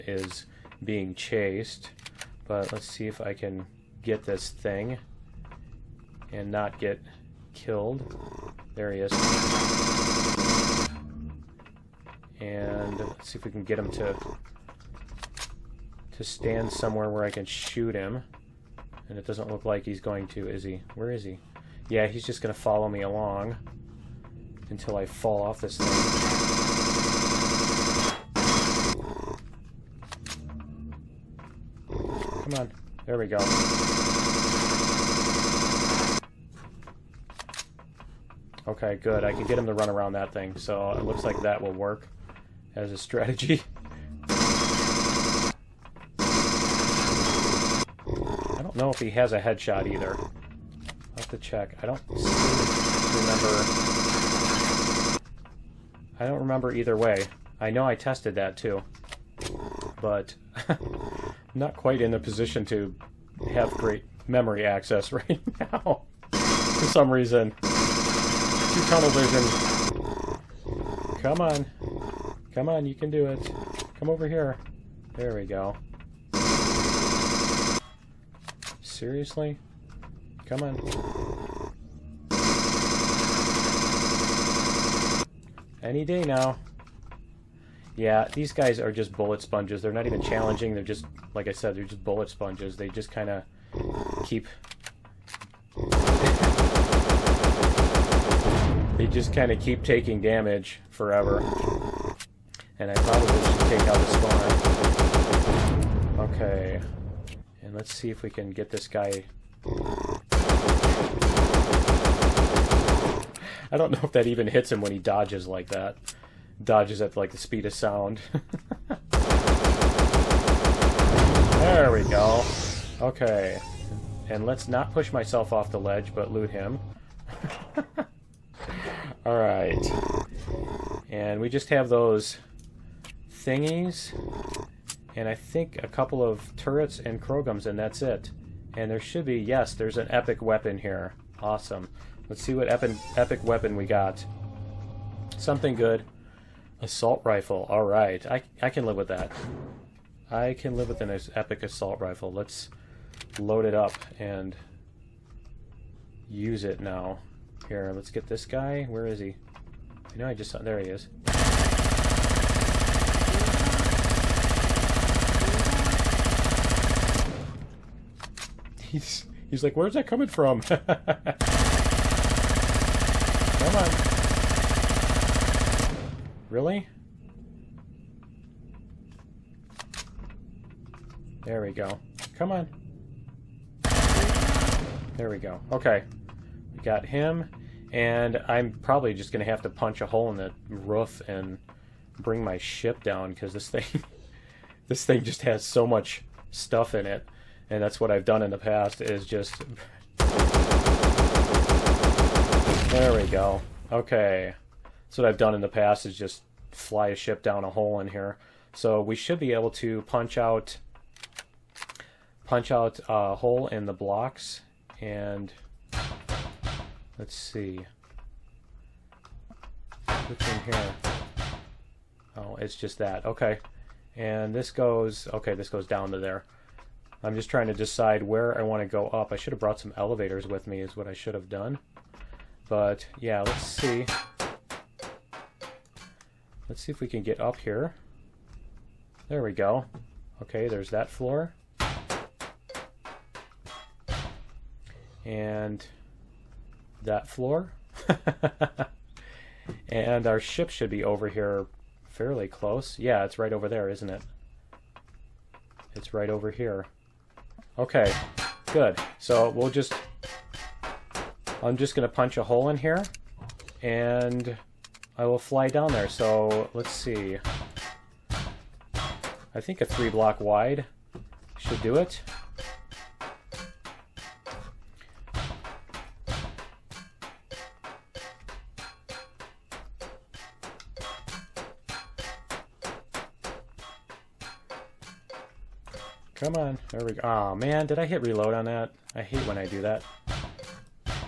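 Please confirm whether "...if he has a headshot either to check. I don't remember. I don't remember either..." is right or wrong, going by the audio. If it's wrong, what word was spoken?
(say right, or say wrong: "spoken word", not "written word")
right.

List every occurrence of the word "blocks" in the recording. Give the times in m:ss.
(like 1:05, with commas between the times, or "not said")
3:33, 4:30.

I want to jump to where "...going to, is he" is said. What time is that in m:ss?
0:20.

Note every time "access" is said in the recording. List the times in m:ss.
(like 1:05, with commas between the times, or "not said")
1:04.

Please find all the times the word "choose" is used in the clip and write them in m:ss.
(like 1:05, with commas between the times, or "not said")
not said.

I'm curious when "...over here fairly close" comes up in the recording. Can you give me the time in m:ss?
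4:11.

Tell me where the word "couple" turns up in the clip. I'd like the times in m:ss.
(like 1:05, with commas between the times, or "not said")
2:15.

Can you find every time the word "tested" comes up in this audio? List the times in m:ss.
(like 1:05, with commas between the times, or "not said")
0:57.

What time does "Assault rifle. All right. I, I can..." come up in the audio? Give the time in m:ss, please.
2:26.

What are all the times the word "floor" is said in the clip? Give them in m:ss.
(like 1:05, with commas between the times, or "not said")
4:01, 4:07.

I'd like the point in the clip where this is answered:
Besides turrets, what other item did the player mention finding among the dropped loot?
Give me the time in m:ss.
2:17.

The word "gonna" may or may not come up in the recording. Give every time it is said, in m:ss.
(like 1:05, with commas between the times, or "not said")
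0:22.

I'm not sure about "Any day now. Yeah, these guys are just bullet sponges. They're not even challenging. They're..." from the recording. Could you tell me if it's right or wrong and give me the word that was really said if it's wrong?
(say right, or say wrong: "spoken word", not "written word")
right.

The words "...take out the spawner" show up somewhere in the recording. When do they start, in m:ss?
1:43.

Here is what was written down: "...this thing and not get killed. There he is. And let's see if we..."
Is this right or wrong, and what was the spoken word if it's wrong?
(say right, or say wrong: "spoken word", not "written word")
right.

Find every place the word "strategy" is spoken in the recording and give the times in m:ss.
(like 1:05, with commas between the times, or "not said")
0:42.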